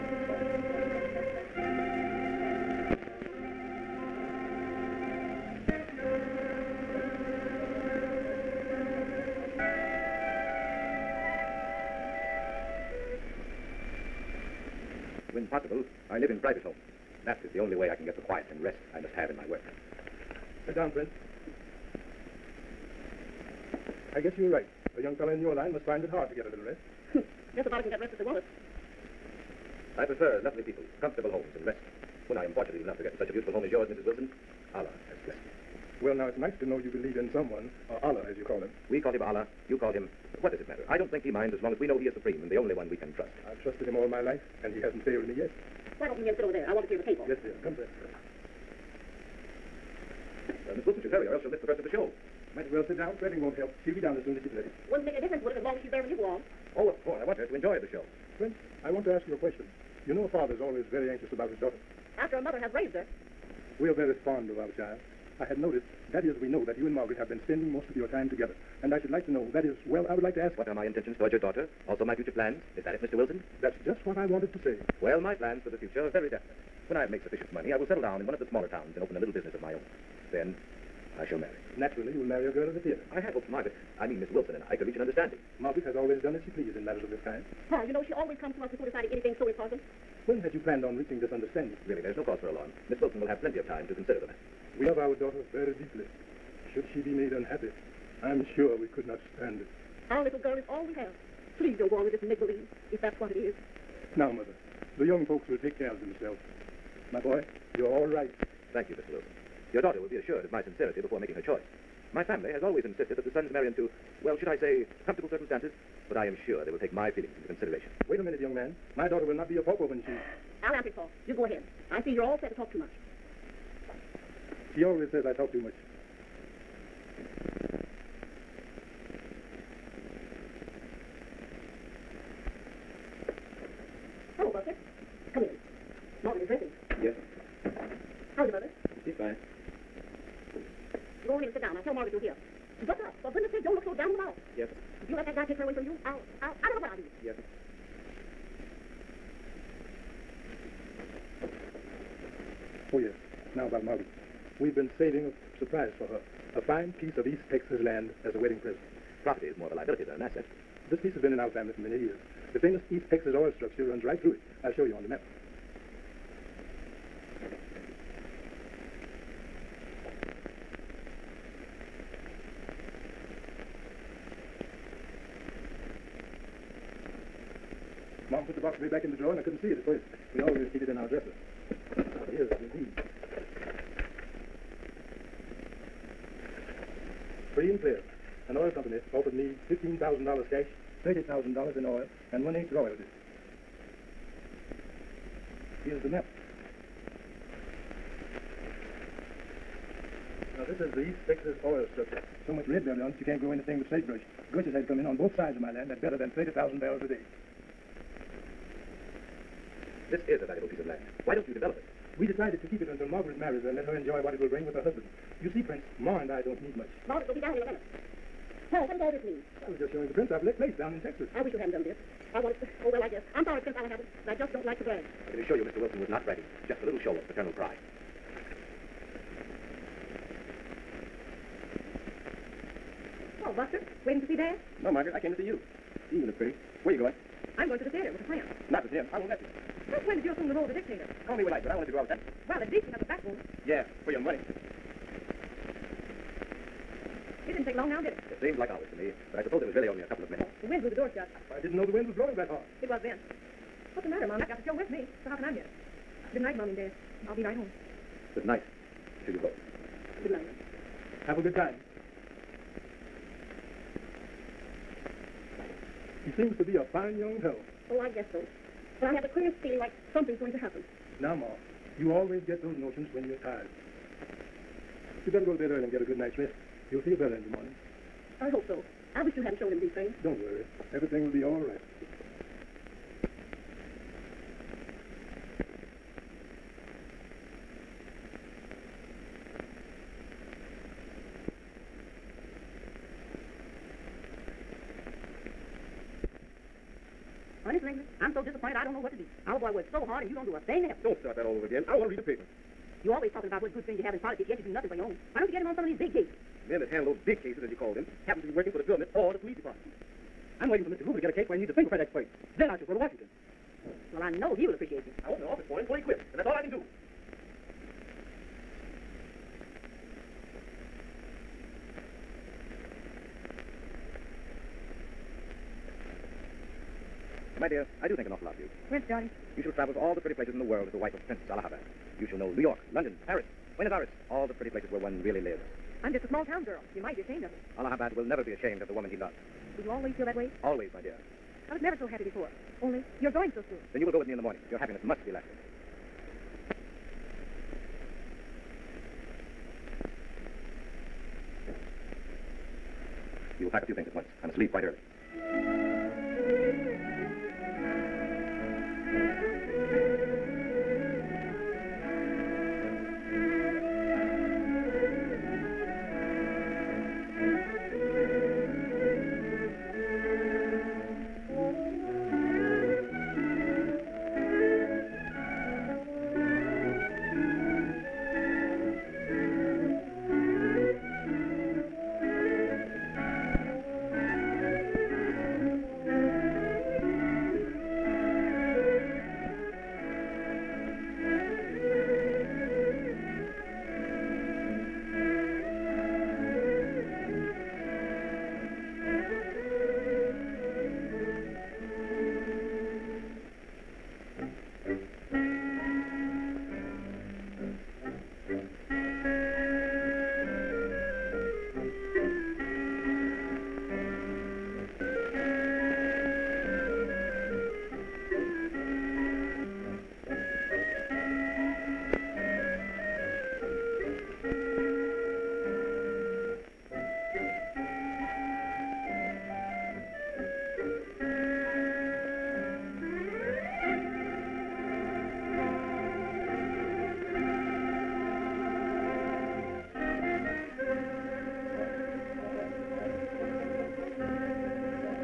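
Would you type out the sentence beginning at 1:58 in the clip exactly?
My daughter will not be a pauper when she...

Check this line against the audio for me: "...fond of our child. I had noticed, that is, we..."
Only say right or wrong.
right.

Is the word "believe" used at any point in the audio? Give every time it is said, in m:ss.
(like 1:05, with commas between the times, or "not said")
0:36, 1:42.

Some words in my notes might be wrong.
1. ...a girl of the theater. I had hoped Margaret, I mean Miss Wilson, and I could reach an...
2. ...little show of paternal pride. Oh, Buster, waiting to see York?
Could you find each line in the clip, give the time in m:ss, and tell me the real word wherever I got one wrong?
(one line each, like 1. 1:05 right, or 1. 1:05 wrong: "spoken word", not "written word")
1. 1:22 right
2. 3:46 wrong: "Dad", not "York".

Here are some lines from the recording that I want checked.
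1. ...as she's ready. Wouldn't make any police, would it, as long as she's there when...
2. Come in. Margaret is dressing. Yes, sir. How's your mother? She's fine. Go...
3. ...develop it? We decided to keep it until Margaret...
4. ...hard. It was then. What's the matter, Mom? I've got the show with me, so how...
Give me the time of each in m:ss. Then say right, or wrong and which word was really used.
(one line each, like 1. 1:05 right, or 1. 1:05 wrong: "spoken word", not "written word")
1. 0:54 wrong: "difference", not "police"
2. 2:15 right
3. 3:31 right
4. 4:12 right.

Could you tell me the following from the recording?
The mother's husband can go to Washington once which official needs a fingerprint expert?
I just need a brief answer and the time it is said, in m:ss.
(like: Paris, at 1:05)
Mr. Hoover, at 5:10.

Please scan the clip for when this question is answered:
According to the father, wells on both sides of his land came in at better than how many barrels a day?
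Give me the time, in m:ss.
3:26.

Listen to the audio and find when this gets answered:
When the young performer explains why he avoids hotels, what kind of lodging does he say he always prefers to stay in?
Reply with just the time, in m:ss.
0:16.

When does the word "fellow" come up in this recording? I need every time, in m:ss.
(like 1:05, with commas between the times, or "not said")
0:25, 4:27.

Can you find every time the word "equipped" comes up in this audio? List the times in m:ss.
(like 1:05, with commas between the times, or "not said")
5:15.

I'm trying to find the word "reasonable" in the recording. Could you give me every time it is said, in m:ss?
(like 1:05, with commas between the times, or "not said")
not said.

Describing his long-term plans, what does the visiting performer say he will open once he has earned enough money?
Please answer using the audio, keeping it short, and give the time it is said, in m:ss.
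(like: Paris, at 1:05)
a little business, at 1:19.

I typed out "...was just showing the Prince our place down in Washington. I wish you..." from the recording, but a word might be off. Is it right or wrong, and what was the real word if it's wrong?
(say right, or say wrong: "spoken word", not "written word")
wrong: "Texas", not "Washington".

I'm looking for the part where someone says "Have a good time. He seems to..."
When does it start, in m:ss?
4:21.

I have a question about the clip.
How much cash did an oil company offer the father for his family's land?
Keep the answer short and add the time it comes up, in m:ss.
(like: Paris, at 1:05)
$15,000, at 3:09.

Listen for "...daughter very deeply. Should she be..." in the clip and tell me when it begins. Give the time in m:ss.
1:35.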